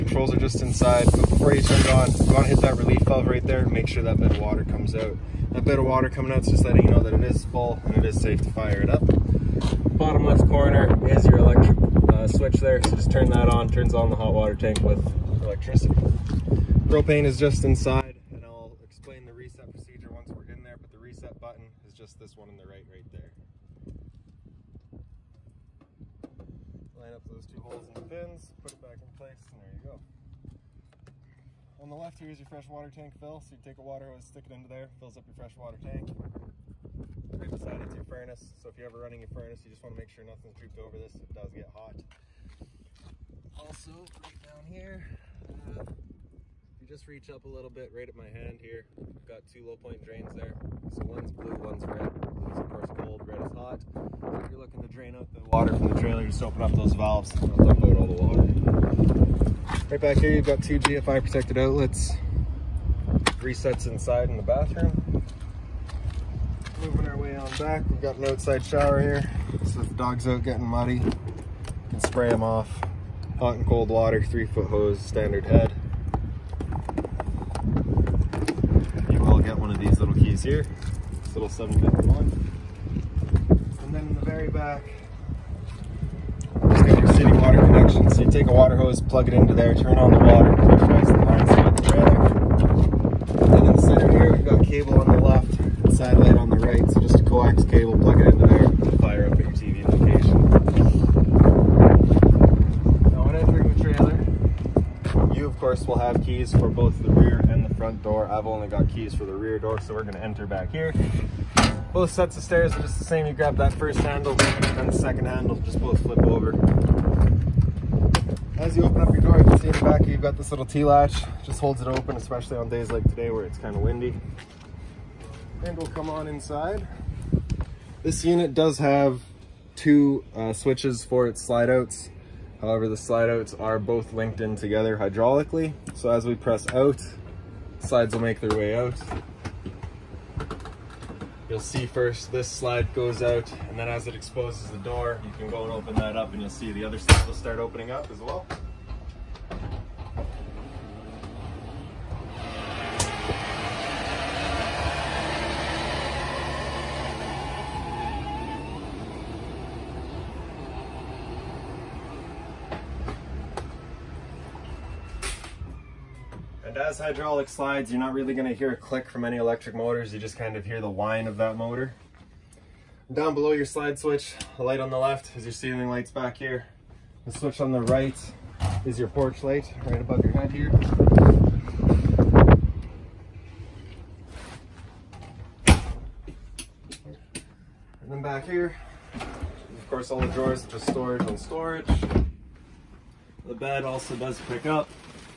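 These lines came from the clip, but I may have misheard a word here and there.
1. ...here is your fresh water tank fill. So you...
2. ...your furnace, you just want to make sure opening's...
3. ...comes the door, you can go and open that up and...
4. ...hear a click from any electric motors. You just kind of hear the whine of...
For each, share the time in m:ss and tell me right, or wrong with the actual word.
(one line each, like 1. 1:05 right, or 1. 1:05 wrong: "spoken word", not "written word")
1. 0:32 right
2. 0:39 wrong: "nothing", not "opening"
3. 2:24 wrong: "exposes", not "comes"
4. 2:48 right.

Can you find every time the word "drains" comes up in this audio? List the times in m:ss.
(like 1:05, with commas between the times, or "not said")
0:50, 0:54.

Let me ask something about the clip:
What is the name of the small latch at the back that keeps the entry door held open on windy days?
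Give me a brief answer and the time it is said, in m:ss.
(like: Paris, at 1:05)
T-latch, at 2:00.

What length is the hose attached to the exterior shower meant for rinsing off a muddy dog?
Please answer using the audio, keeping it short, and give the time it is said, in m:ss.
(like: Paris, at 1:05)
3 foot, at 1:14.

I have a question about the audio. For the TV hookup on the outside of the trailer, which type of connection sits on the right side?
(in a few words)
Satellite.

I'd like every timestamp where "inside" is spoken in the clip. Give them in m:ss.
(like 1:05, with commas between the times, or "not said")
0:00, 0:17, 1:03, 2:06.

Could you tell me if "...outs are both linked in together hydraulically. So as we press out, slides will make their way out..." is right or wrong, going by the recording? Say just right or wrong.
right.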